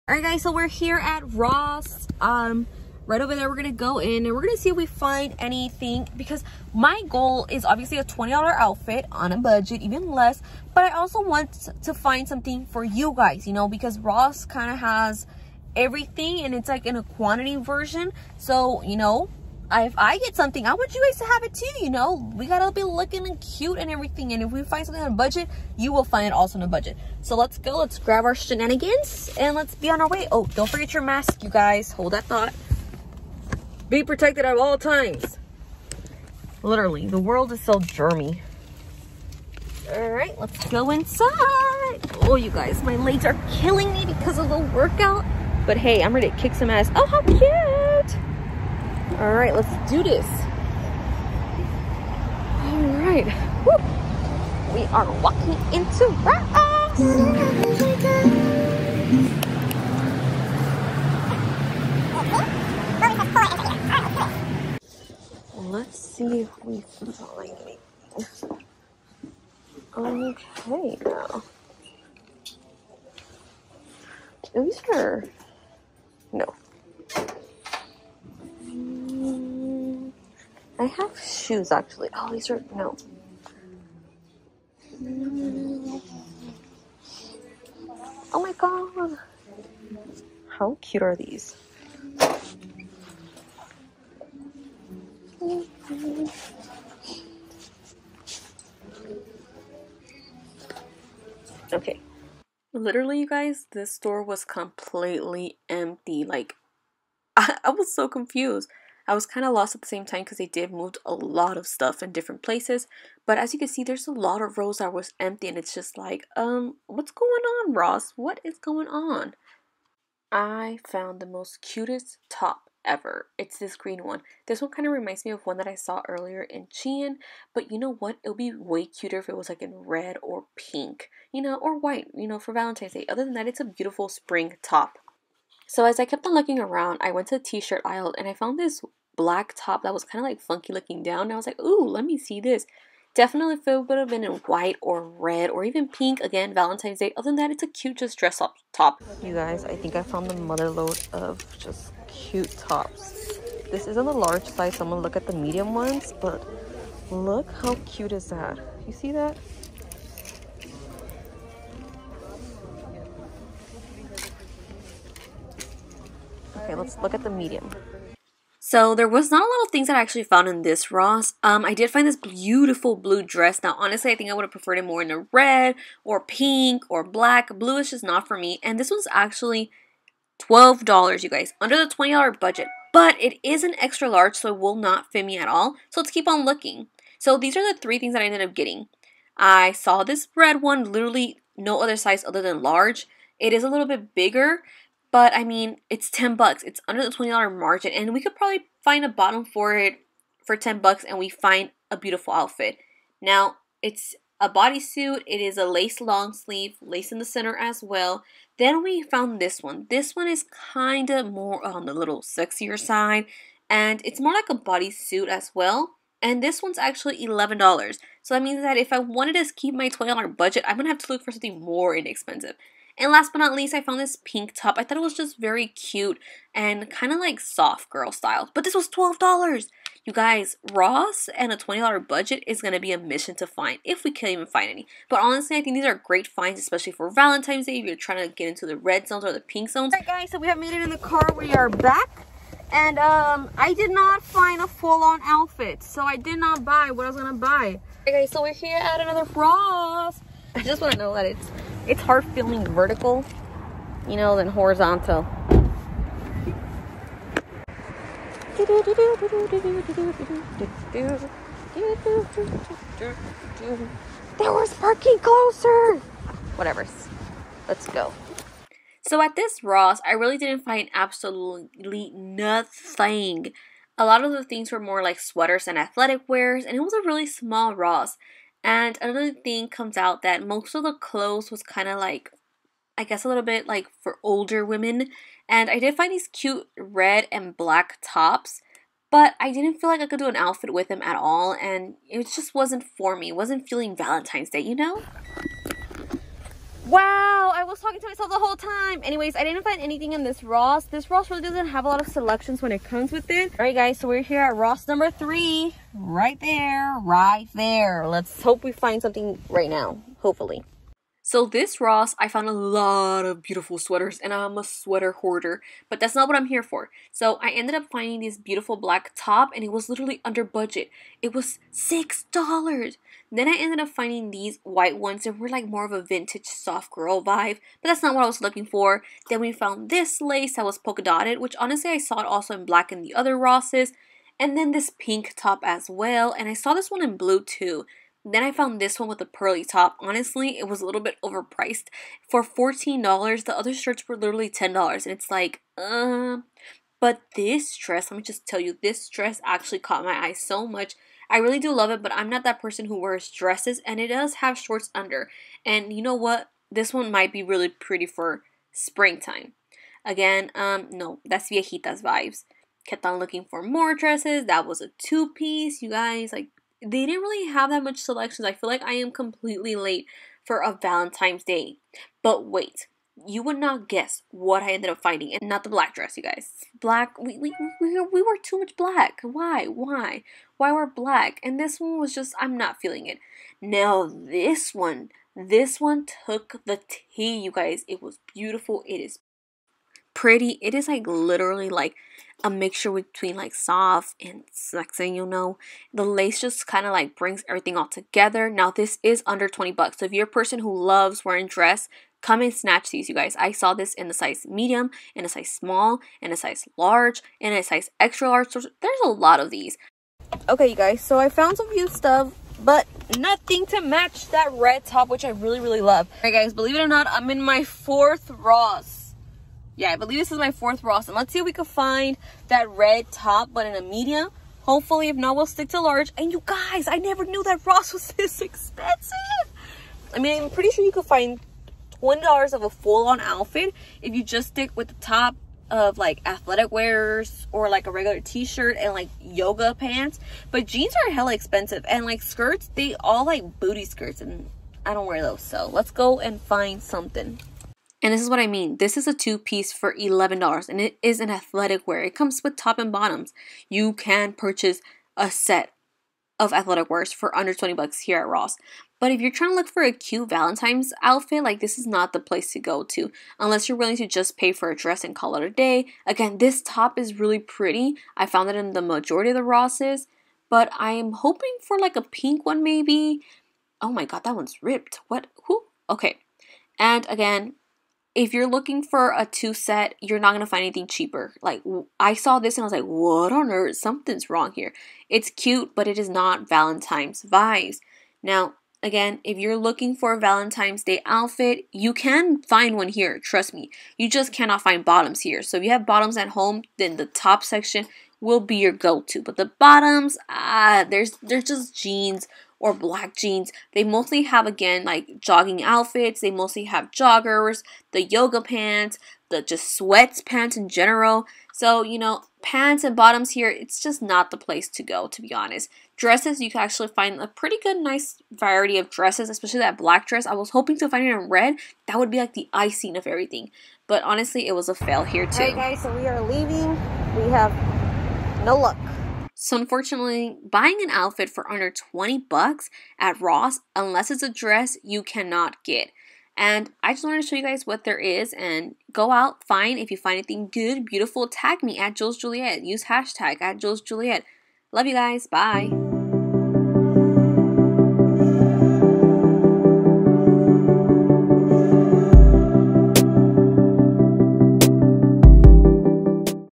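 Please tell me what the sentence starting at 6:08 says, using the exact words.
I feel like I am completely late for a Valentine's Day.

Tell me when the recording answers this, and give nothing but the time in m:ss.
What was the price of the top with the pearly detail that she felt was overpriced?
5:42.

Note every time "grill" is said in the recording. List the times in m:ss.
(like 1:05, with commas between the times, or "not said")
not said.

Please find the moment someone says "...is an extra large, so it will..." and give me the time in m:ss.
3:03.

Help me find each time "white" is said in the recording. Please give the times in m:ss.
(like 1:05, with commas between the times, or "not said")
2:11, 2:24, 5:24.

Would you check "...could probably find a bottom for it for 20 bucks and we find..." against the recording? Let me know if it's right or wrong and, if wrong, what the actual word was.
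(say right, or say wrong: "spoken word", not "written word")
wrong: "10", not "20".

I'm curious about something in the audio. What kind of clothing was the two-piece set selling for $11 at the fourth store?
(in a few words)
Athletic wear.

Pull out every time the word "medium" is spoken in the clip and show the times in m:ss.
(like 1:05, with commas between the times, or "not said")
2:35, 2:47, 6:44, 7:03.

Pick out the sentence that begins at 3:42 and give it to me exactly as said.
And last but not least, I found this pink top.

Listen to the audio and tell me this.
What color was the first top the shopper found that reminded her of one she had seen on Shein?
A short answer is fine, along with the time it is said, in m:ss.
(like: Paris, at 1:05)
Green, at 2:03.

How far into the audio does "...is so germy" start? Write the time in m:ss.
0:37.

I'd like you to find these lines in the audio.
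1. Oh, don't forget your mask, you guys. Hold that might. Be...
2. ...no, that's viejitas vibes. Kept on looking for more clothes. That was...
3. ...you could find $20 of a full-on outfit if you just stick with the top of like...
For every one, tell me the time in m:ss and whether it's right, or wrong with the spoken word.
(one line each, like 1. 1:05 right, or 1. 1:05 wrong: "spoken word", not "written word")
1. 0:30 wrong: "thought", not "might"
2. 6:00 wrong: "dresses", not "clothes"
3. 7:10 right.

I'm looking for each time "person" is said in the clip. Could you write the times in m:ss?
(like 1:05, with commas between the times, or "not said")
5:52, 6:40.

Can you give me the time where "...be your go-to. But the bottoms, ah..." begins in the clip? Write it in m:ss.
8:18.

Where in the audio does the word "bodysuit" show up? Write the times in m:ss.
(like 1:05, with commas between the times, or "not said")
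3:24, 3:34.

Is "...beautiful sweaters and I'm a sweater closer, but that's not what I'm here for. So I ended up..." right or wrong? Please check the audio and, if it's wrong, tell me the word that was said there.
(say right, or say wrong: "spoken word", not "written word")
wrong: "hoarder", not "closer".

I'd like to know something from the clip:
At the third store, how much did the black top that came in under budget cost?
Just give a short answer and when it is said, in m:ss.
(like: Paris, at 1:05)
$6, at 5:21.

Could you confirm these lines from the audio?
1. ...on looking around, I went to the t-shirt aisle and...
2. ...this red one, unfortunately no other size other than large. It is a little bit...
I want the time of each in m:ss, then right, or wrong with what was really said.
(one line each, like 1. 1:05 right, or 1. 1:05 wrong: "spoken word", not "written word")
1. 2:16 right
2. 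3:10 wrong: "literally", not "unfortunately".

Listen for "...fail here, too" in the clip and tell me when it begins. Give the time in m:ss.
8:44.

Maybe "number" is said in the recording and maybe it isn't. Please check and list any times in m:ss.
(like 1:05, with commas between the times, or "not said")
5:04.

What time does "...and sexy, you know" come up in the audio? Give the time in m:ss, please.
6:34.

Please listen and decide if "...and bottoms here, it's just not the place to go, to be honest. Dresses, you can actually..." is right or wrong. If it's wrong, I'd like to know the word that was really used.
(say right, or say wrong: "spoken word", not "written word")
right.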